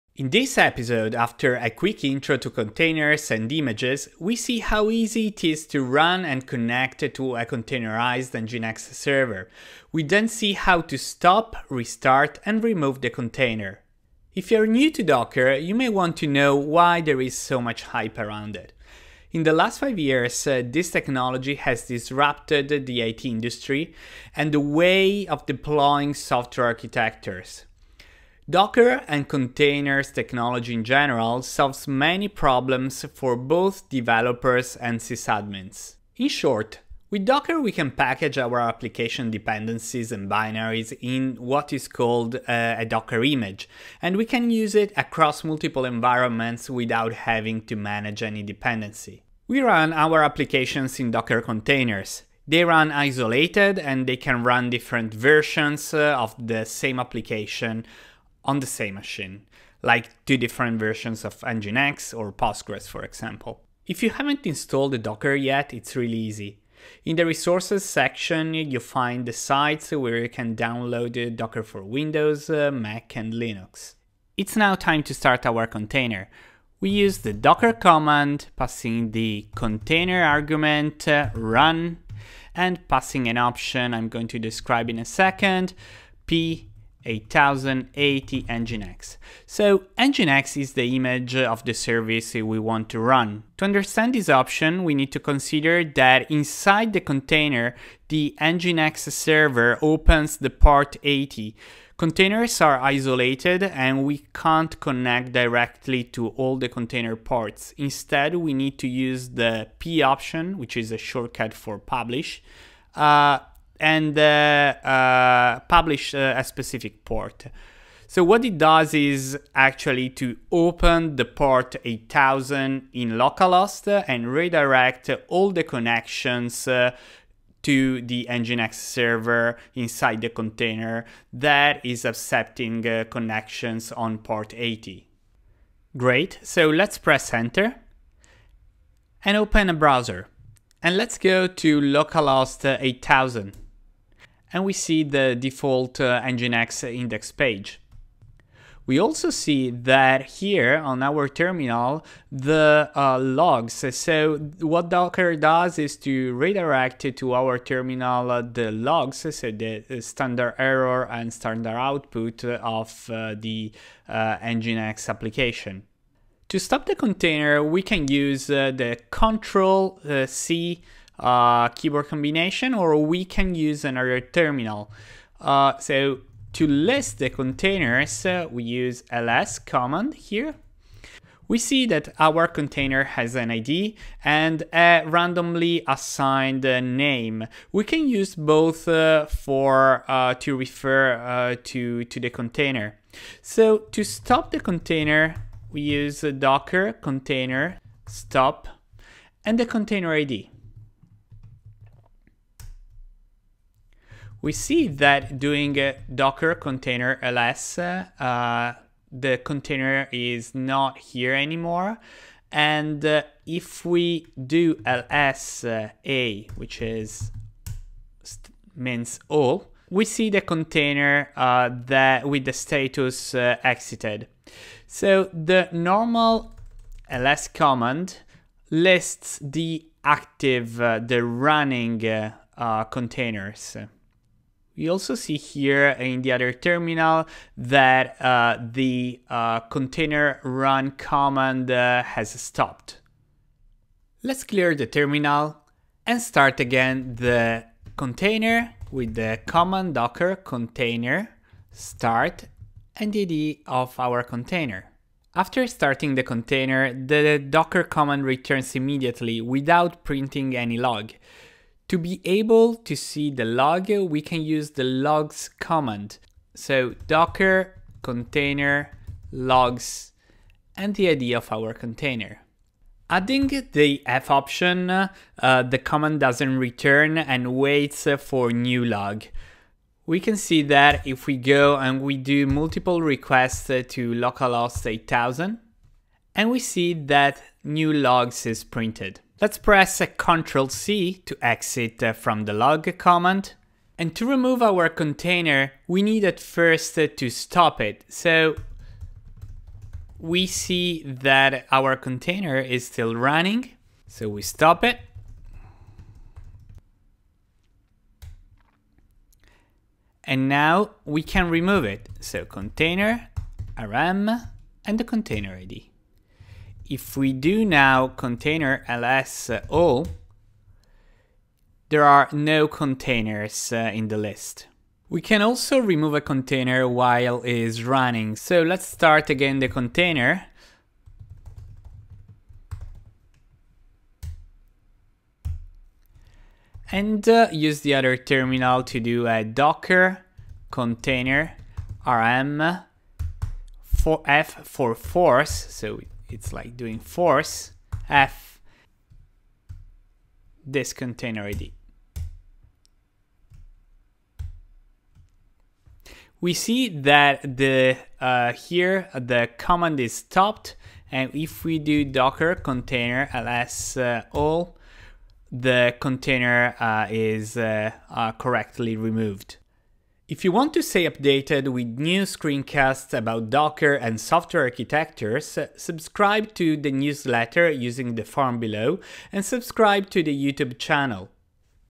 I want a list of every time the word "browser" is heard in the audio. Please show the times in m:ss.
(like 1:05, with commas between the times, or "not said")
2:19.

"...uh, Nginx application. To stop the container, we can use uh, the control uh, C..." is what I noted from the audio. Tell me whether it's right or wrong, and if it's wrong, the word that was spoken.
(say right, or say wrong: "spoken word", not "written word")
right.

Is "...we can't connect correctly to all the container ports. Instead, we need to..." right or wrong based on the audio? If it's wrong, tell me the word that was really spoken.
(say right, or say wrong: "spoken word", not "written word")
wrong: "directly", not "correctly".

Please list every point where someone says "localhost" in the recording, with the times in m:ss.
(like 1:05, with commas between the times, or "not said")
2:03, 2:21, 4:44.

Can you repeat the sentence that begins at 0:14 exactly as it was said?
If you're new to Docker, you may want to know why there is so much hype around it.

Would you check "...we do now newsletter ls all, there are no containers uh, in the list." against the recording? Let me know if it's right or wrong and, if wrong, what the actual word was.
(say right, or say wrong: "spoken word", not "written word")
wrong: "container", not "newsletter".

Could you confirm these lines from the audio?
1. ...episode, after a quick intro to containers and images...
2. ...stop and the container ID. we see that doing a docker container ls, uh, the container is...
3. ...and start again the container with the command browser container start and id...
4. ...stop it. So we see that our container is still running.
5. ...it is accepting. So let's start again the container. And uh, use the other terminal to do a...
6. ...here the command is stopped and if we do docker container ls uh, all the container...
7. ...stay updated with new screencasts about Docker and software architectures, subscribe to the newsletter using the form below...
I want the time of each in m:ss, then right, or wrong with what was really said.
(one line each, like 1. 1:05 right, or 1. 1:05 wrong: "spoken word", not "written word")
1. 0:00 right
2. 3:18 right
3. 4:06 wrong: "docker", not "browser"
4. 4:57 right
5. 5:27 wrong: "running", not "accepting"
6. 5:58 right
7. 6:10 right.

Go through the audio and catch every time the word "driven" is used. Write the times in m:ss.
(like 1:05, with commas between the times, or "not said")
not said.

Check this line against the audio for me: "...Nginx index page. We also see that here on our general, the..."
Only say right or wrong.
wrong.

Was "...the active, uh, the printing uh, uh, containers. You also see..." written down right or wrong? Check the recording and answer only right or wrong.
wrong.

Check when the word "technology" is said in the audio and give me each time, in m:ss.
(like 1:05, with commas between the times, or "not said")
0:20, 0:30.